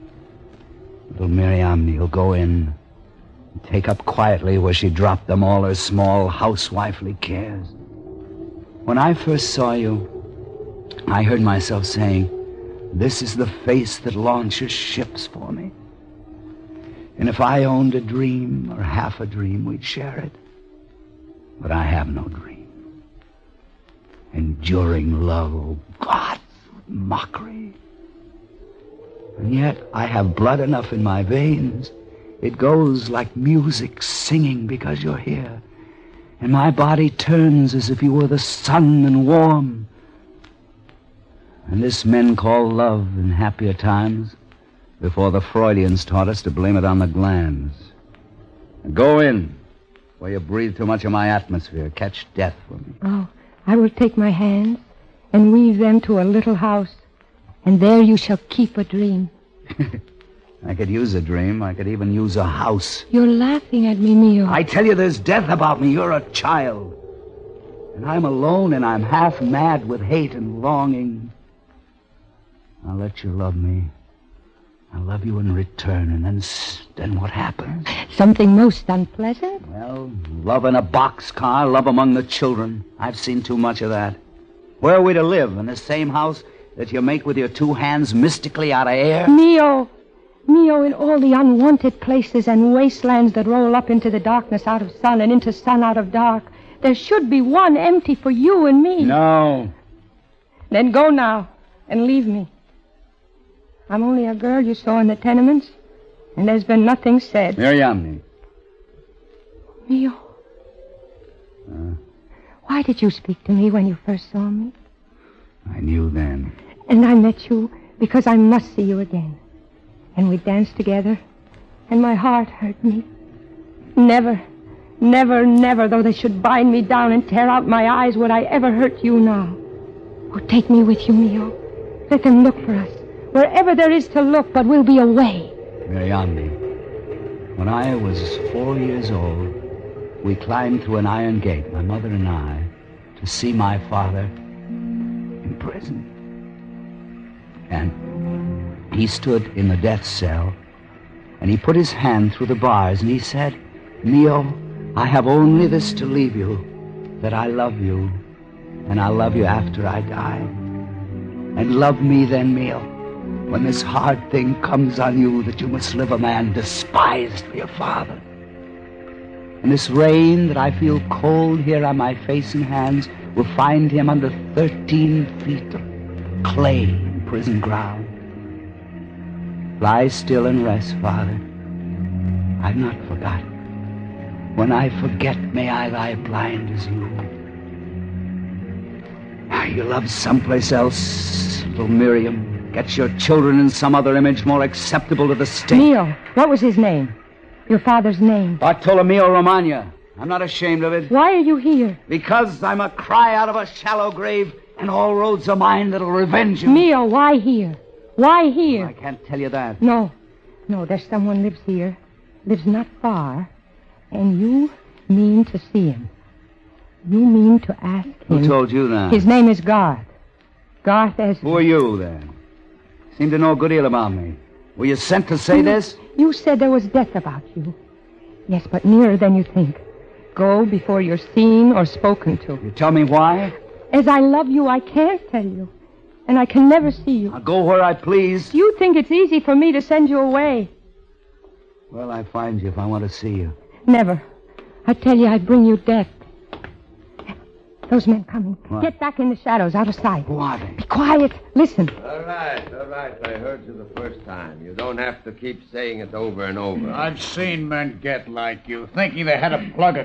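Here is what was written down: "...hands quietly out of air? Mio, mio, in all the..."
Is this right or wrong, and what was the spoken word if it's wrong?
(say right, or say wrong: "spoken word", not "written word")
wrong: "mystically", not "quietly".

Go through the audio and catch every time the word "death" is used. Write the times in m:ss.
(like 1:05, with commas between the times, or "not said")
0:52, 1:05, 2:29, 3:46, 4:05.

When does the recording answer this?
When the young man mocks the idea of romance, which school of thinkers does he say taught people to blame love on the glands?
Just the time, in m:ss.
0:45.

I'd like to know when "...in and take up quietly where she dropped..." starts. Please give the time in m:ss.
0:02.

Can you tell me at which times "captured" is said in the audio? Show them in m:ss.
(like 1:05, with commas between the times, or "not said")
not said.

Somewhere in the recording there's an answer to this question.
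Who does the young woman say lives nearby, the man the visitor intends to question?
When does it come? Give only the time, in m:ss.
3:40.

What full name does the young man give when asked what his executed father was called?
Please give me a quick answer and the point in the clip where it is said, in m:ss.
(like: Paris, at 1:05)
Bartolomeo Romagna, at 3:18.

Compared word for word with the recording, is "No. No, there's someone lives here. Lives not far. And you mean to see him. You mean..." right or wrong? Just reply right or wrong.
right.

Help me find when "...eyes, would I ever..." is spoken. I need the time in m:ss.
2:07.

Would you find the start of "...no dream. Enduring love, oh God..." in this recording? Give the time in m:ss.
0:22.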